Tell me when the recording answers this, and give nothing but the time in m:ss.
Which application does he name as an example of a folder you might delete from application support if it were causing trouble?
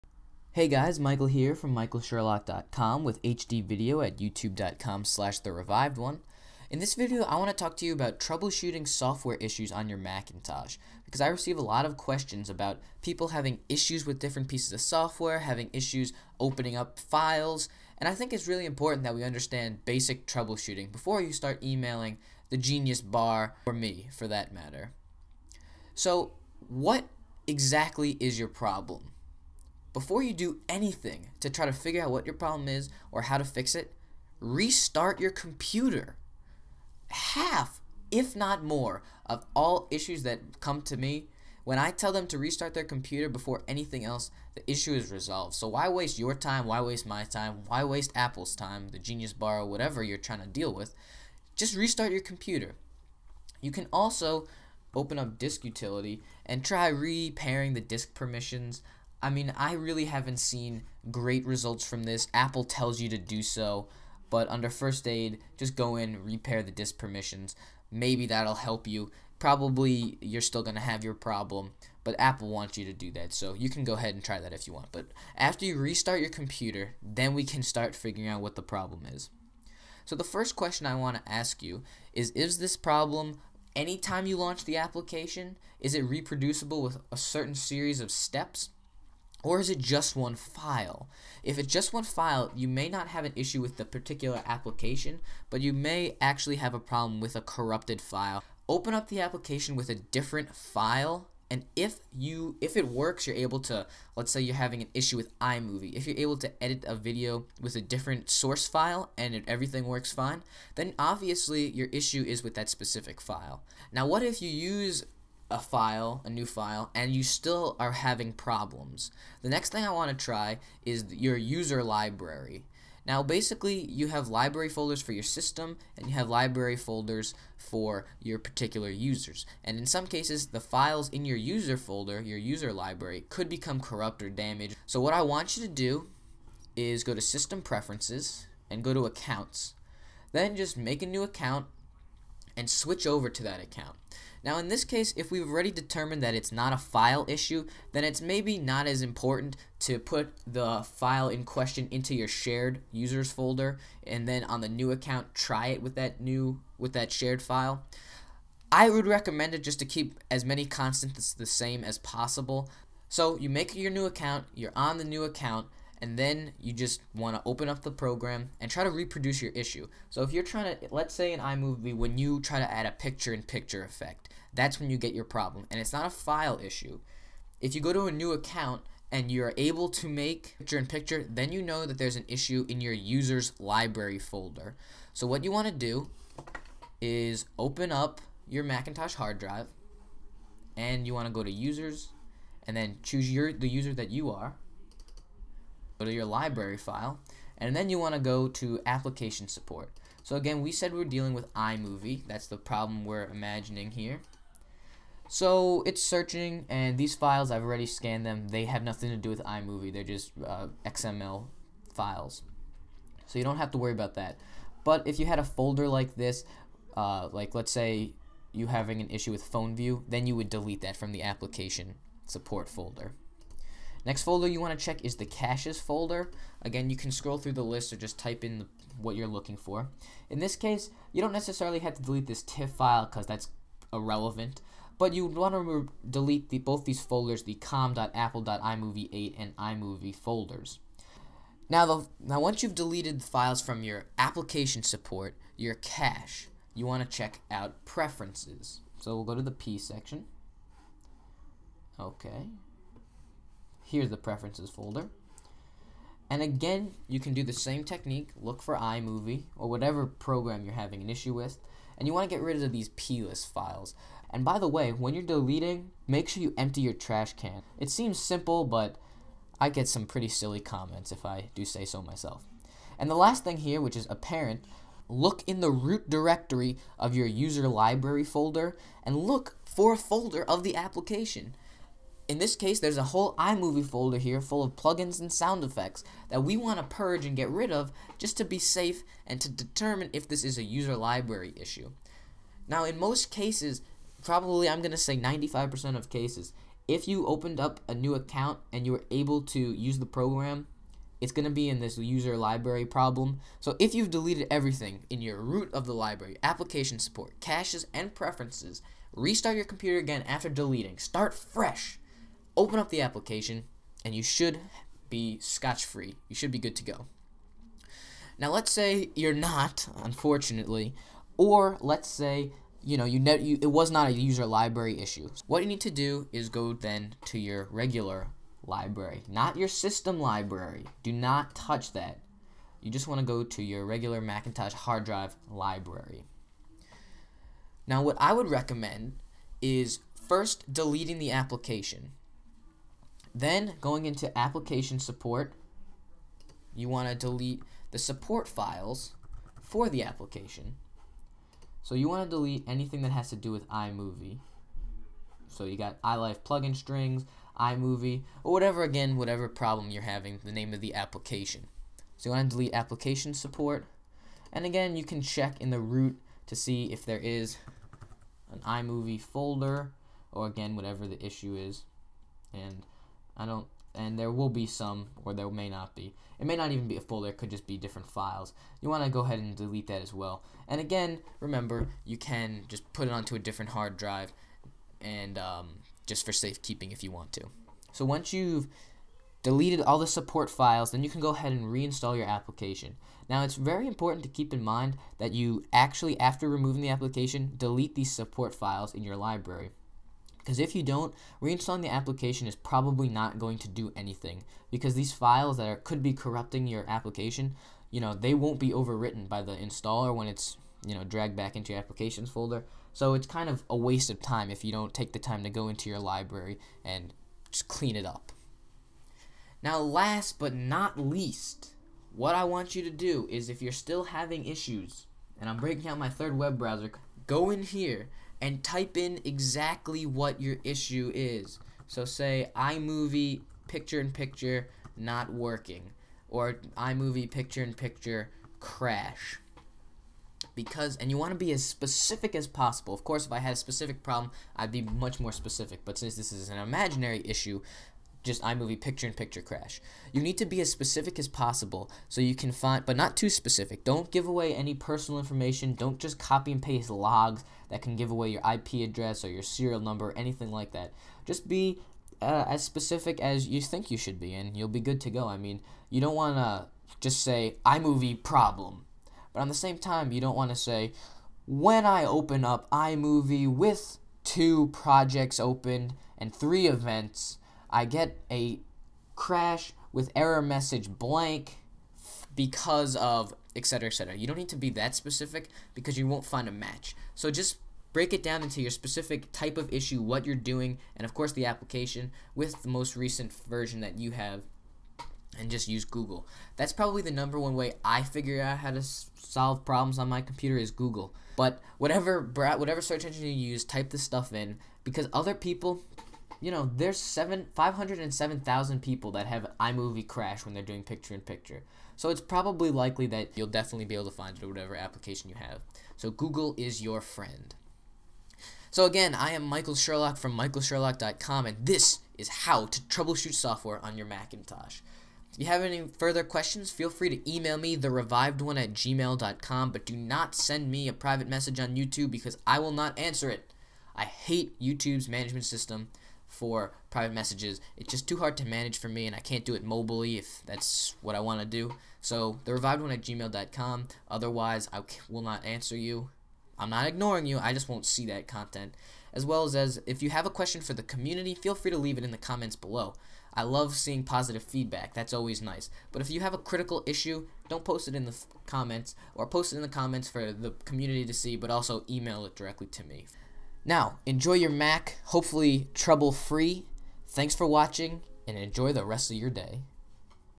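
3:39.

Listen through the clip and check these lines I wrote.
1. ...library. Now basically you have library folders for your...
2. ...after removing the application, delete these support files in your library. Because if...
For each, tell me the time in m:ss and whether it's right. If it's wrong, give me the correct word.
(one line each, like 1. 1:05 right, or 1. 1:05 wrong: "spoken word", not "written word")
1. 2:01 right
2. 6:36 right.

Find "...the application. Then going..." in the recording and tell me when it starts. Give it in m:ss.
5:41.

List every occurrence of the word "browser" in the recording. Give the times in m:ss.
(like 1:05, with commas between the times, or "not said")
7:06.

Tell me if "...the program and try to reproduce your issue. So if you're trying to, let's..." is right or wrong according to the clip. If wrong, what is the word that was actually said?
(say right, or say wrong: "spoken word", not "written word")
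right.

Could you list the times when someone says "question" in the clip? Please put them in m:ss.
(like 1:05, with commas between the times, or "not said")
0:11, 1:20, 2:31, 8:46, 9:10.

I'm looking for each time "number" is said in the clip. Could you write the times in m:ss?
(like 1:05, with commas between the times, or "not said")
7:39, 8:17.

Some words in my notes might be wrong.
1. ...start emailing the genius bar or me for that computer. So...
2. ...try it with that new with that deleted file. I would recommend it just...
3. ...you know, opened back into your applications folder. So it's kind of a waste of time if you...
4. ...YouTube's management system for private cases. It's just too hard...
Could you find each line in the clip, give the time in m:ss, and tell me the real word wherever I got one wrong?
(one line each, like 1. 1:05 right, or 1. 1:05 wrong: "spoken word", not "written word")
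1. 0:21 wrong: "matter", not "computer"
2. 2:35 wrong: "shared", not "deleted"
3. 6:50 wrong: "dragged", not "opened"
4. 8:54 wrong: "messages", not "cases".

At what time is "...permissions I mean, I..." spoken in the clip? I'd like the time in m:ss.
0:58.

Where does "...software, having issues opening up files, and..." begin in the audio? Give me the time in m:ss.
0:14.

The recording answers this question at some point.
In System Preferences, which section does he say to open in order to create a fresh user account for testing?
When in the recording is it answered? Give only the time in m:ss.
2:19.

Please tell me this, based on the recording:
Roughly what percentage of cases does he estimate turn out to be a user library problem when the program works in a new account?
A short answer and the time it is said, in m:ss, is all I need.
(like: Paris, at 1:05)
95%, at 4:55.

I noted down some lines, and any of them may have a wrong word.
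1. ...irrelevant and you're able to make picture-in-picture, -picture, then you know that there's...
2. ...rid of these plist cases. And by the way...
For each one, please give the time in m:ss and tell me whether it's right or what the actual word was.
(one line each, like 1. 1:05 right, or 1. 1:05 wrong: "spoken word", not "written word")
1. 2:58 wrong: "account", not "irrelevant"
2. 4:22 wrong: "files", not "cases".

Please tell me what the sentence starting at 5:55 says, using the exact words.
So you got iLife plugin strings, iMovie, or whatever again, whatever problem you're having, the name of the application.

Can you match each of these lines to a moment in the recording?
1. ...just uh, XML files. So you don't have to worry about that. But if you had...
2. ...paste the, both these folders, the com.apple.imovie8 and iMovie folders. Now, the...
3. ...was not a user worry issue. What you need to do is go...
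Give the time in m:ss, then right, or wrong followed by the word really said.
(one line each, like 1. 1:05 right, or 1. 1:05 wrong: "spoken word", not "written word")
1. 3:30 right
2. 3:56 wrong: "delete", not "paste"
3. 5:23 wrong: "library", not "worry".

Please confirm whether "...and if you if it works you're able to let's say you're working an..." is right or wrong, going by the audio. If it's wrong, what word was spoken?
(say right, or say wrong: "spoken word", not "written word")
wrong: "having", not "working".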